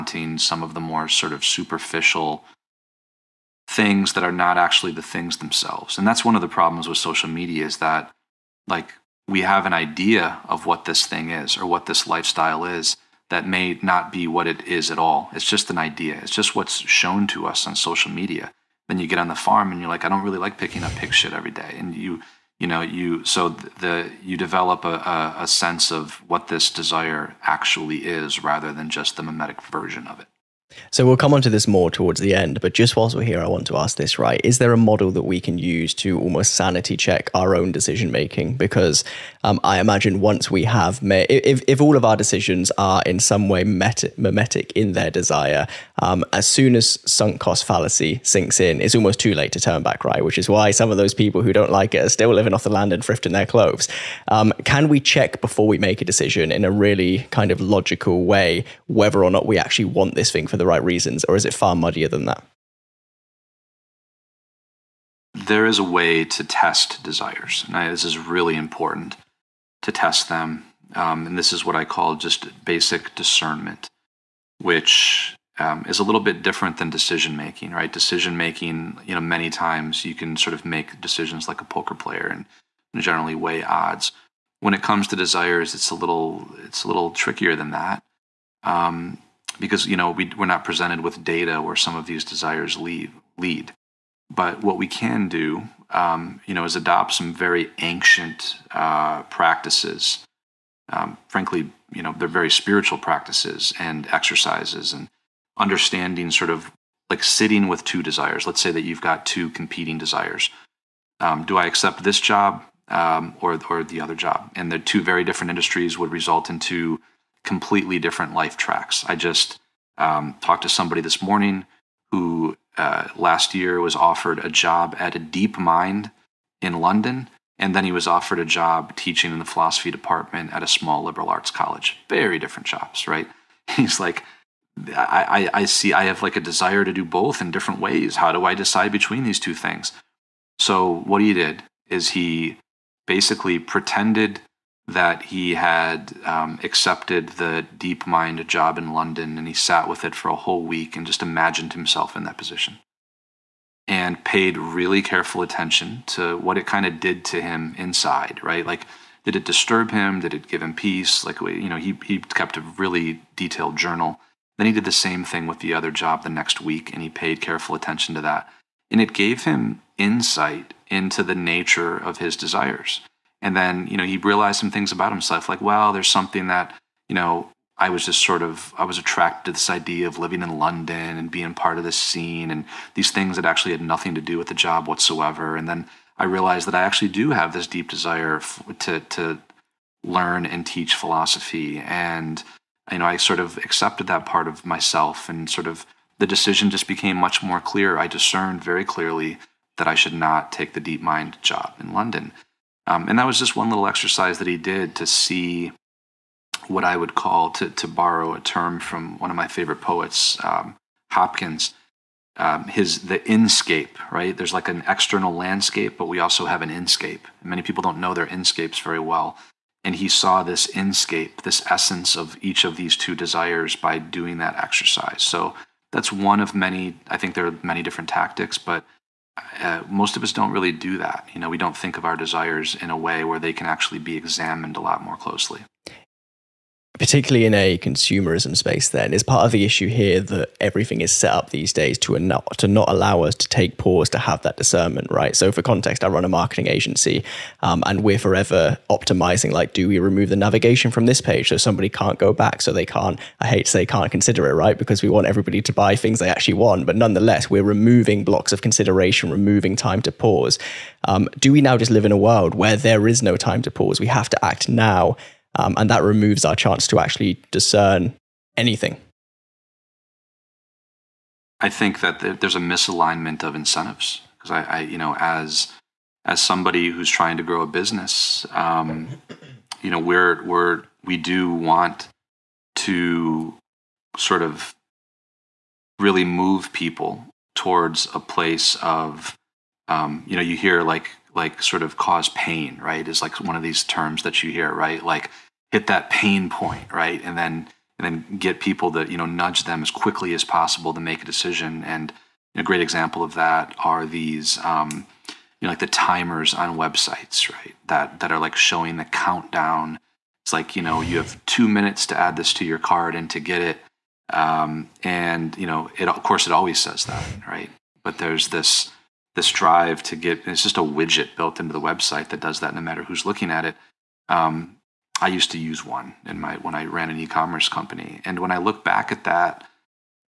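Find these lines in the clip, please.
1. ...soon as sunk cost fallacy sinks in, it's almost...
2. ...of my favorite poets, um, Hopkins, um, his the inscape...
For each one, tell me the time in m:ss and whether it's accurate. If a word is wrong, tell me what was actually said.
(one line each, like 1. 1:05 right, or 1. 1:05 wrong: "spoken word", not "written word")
1. 0:46 right
2. 3:29 right.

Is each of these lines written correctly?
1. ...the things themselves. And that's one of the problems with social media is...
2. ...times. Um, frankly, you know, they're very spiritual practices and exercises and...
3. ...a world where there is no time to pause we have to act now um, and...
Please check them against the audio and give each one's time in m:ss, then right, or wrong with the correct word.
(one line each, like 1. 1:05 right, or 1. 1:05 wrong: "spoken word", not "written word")
1. 0:04 right
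2. 1:39 wrong: "practices", not "times"
3. 4:22 right.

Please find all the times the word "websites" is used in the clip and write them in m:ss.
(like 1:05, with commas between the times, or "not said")
5:06, 5:21.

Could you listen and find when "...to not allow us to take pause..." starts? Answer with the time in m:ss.
4:02.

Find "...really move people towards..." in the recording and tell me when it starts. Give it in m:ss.
4:45.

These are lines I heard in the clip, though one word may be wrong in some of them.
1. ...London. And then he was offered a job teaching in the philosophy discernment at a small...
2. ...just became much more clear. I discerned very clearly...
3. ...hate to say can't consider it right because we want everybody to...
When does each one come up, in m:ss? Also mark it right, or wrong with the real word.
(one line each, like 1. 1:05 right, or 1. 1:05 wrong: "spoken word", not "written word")
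1. 2:06 wrong: "department", not "discernment"
2. 3:16 right
3. 4:13 right.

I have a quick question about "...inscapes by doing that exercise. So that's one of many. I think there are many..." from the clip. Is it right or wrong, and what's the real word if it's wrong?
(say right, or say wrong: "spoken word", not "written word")
wrong: "desires", not "inscapes".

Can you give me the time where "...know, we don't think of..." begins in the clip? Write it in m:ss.
3:51.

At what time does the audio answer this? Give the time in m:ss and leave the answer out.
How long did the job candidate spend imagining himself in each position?
2:30.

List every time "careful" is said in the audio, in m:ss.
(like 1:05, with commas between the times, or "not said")
2:35, 2:47.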